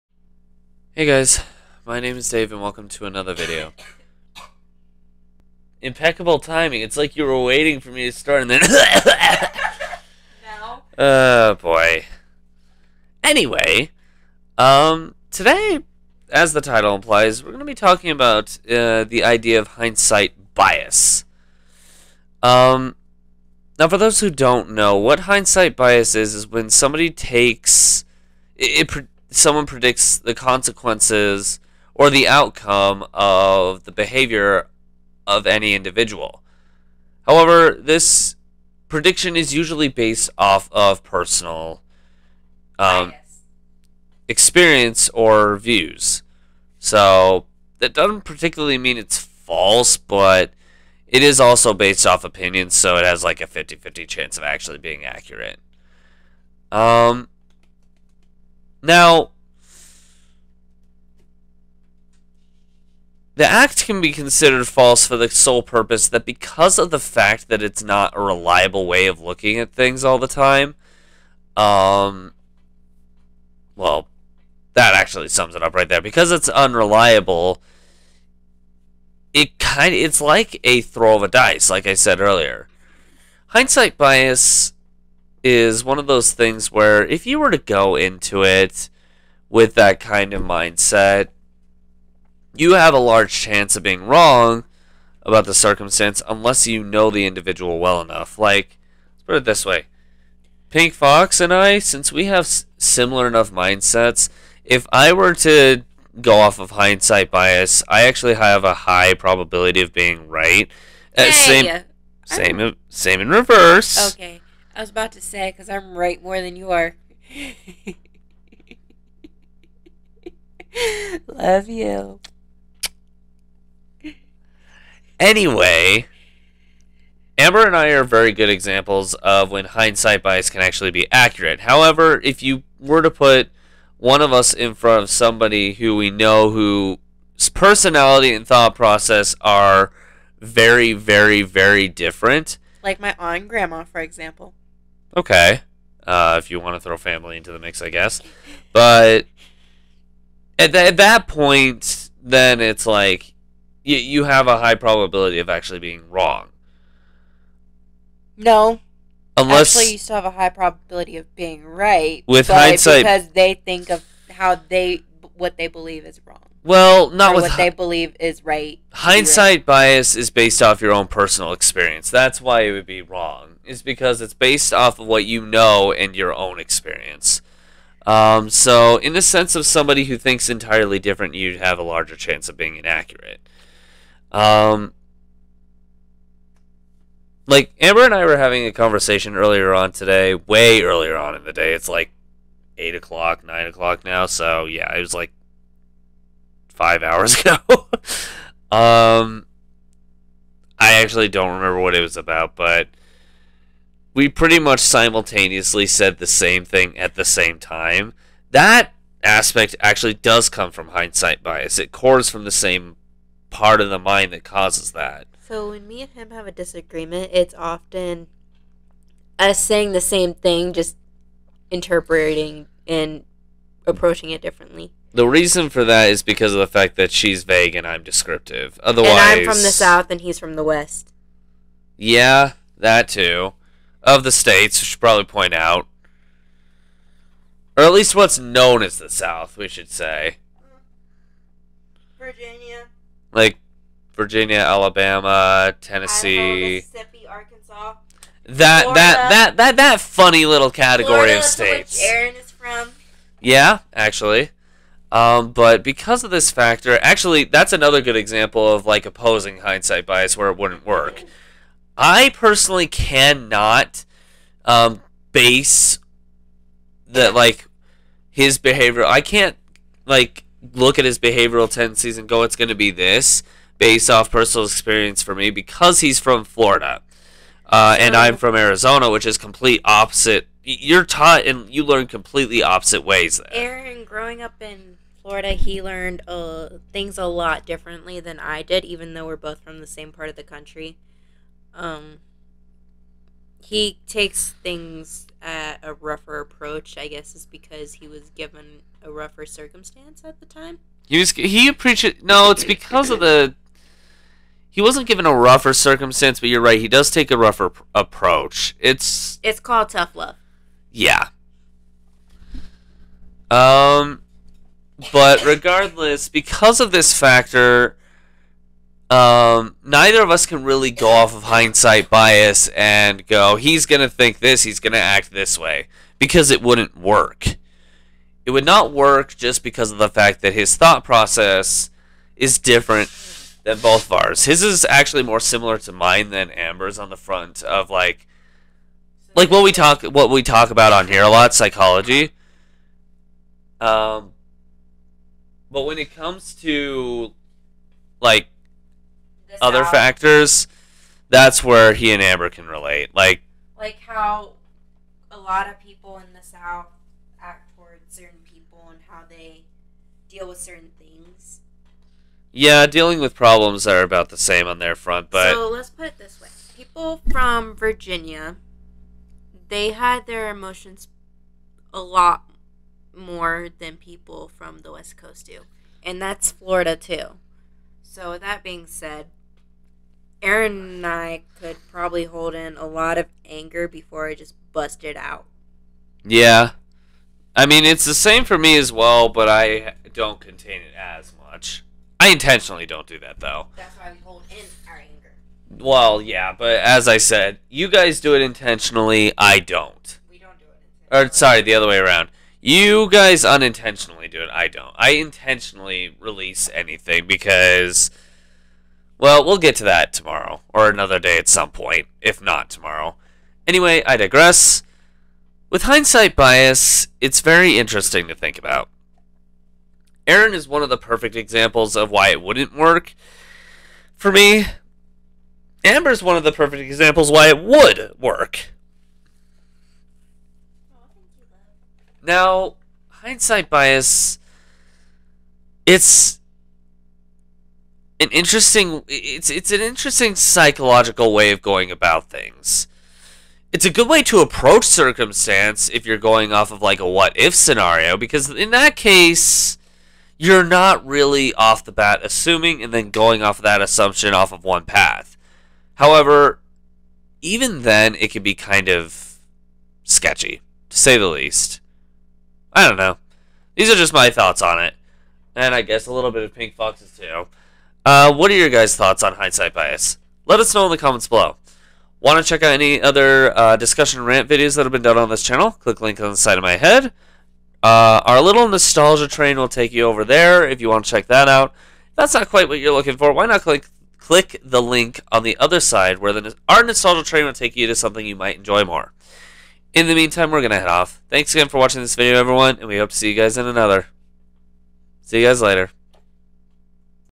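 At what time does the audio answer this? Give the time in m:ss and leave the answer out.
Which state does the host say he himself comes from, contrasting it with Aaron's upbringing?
4:38.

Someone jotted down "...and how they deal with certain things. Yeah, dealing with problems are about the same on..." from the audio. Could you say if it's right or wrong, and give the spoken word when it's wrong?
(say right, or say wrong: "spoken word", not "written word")
right.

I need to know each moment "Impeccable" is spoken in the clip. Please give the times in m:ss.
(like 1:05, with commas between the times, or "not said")
0:05.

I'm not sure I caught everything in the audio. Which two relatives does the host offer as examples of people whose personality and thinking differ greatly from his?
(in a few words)
aunt and grandma.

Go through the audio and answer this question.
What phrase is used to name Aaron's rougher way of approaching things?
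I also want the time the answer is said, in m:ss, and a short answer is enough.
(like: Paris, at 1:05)
tough love, at 5:09.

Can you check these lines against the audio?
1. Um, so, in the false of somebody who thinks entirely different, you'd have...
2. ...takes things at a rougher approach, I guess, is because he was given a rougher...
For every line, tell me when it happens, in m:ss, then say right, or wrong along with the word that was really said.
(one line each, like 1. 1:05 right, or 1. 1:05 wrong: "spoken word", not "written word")
1. 2:58 wrong: "sense", not "false"
2. 4:54 right.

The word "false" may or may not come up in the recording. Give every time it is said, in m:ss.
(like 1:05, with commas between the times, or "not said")
0:49, 1:04.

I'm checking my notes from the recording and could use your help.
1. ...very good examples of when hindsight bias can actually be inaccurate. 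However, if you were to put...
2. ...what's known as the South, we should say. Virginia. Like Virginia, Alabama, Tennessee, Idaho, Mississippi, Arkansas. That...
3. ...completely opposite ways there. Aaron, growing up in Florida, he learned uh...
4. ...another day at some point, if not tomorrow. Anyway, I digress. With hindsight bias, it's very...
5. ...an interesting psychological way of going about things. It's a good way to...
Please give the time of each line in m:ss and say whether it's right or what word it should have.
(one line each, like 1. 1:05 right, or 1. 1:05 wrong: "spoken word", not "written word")
1. 2:08 wrong: "accurate", not "inaccurate"
2. 3:58 right
3. 4:42 right
4. 6:50 right
5. 7:19 right.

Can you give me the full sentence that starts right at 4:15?
Um, but because of this factor, actually, that's another good example of like opposing hindsight bias where it wouldn't work.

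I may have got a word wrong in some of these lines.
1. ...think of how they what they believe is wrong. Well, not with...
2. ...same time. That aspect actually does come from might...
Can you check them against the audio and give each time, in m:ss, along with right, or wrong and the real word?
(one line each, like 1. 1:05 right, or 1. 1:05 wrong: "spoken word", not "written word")
1. 2:43 right
2. 3:27 wrong: "hindsight", not "might".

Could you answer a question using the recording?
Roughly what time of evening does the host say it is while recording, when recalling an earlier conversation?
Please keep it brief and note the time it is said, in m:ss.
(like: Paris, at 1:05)
8 or 9 o'clock, at 3:12.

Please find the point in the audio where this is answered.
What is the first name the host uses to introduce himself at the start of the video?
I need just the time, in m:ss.
0:02.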